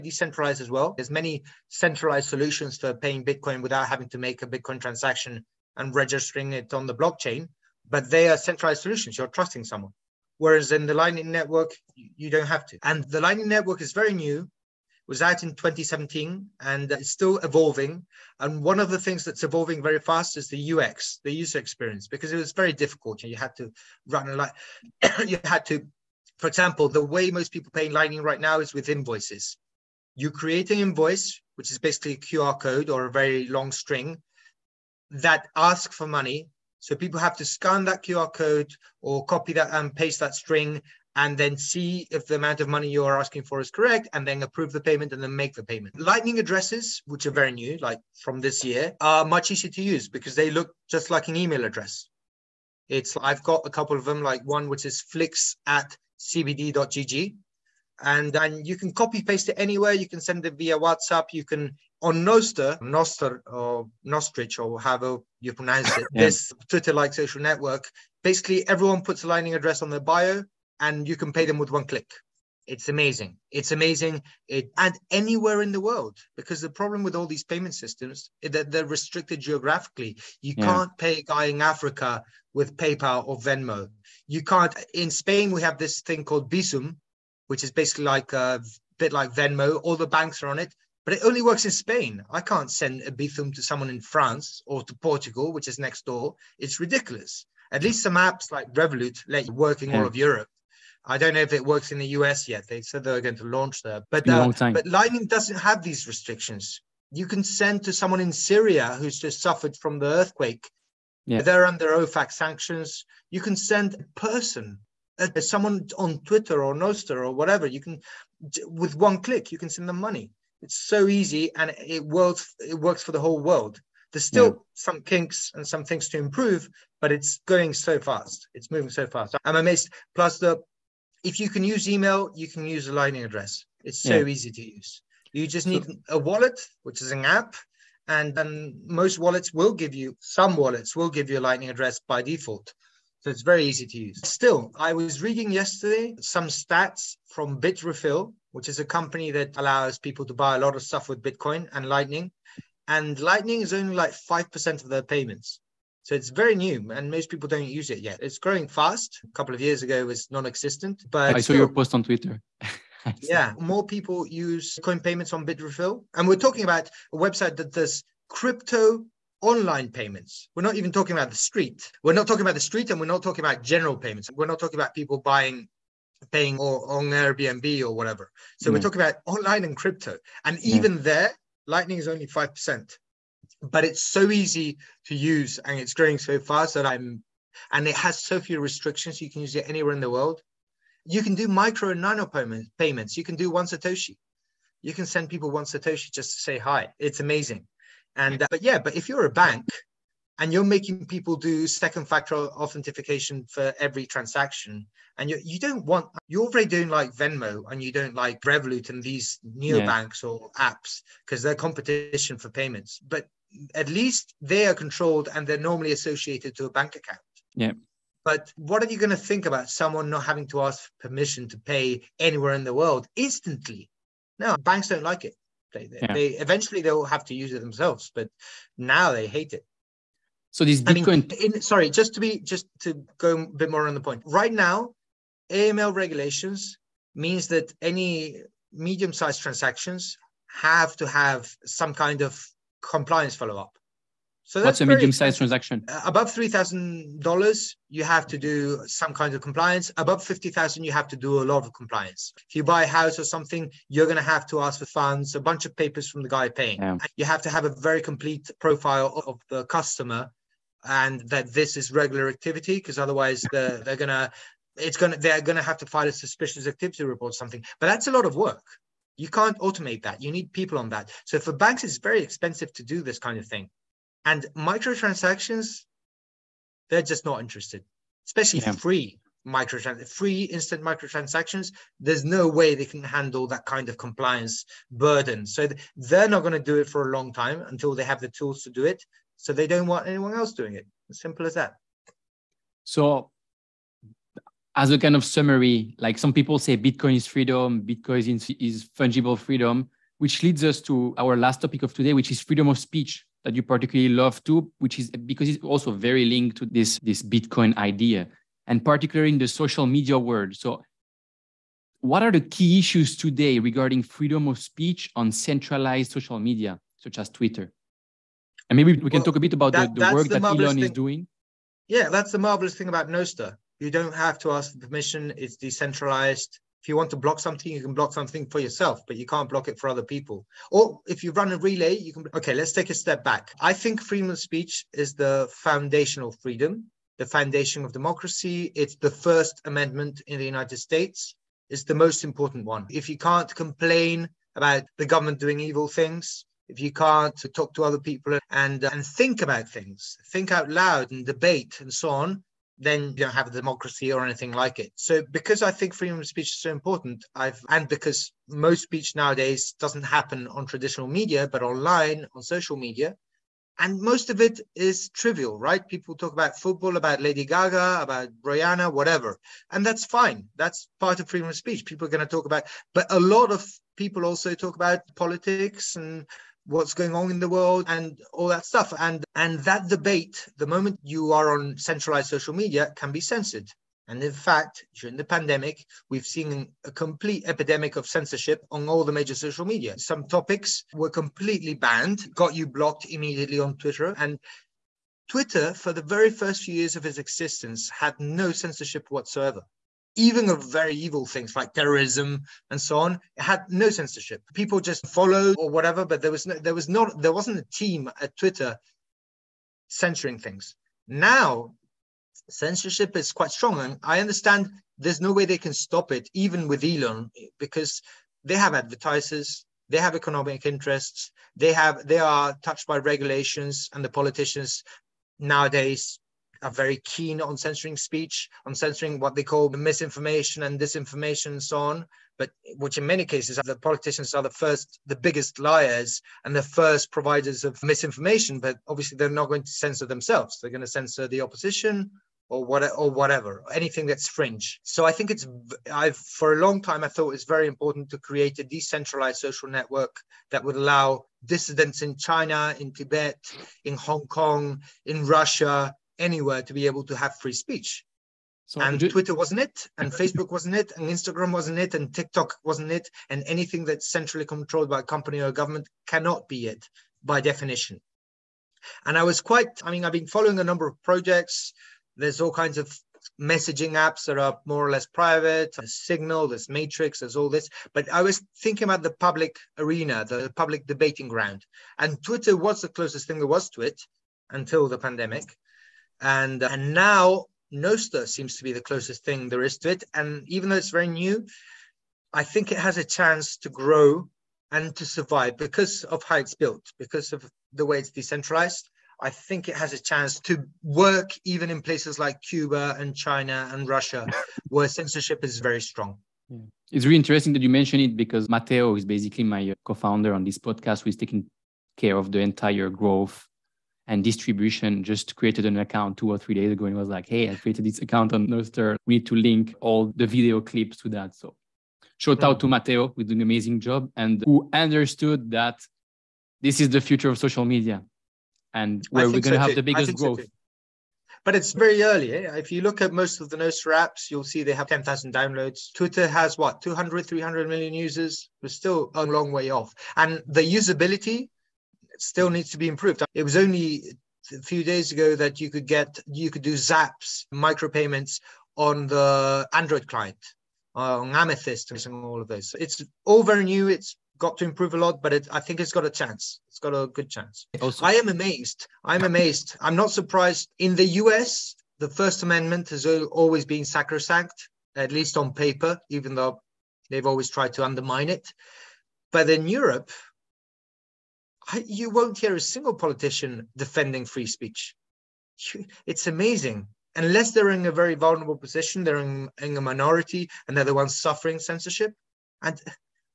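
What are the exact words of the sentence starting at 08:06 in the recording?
And, and now Nostr seems to be the closest thing there is to it.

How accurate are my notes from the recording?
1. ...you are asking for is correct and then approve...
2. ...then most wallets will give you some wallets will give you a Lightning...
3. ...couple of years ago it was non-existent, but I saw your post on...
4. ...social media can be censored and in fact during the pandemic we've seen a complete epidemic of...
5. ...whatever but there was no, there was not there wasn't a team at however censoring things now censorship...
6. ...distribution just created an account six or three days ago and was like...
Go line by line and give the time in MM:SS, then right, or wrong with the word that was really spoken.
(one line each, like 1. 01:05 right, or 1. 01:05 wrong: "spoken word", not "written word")
1. 00:42 right
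2. 02:18 right
3. 02:39 right
4. 06:22 right
5. 06:45 wrong: "twitter", not "however"
6. 08:34 wrong: "two", not "six".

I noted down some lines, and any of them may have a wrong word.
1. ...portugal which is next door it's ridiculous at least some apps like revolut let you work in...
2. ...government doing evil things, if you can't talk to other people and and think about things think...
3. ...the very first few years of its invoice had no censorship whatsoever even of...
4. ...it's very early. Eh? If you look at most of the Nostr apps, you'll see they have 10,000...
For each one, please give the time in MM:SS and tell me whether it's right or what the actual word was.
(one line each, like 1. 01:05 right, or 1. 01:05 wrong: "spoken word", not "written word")
1. 01:34 right
2. 05:45 right
3. 06:35 wrong: "existence", not "invoice"
4. 08:51 right.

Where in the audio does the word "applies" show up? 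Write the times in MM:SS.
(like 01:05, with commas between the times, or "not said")
not said.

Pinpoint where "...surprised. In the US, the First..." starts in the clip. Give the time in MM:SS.
09:20.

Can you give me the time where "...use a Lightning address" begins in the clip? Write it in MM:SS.
02:12.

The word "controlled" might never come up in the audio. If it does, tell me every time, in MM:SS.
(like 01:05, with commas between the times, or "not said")
03:34, 07:44.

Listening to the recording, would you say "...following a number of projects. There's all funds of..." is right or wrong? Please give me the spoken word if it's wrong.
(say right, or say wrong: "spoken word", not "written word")
wrong: "kinds", not "funds".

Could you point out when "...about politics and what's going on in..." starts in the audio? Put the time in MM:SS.
06:14.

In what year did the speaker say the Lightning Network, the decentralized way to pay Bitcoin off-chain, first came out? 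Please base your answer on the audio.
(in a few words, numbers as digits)
2017.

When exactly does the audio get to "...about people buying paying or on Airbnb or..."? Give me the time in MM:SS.
02:54.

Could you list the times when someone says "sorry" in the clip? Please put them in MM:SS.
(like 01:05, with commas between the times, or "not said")
03:51.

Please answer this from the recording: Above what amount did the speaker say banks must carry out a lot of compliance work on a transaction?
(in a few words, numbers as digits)
50000.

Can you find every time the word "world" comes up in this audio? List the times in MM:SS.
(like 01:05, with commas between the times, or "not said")
01:15, 02:03, 03:10, 03:42, 05:10, 06:17.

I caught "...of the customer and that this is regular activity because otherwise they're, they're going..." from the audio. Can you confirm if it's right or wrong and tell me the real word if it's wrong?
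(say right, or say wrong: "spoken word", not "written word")
right.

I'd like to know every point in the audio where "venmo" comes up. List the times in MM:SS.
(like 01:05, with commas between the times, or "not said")
01:23, 01:29, 03:27.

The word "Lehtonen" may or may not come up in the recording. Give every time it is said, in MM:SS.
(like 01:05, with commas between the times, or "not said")
not said.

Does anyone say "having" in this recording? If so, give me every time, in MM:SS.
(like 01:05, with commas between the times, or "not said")
00:03, 03:40.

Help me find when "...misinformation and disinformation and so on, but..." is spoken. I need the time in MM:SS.
07:09.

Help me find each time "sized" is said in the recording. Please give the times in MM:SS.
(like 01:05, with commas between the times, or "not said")
03:58, 04:05.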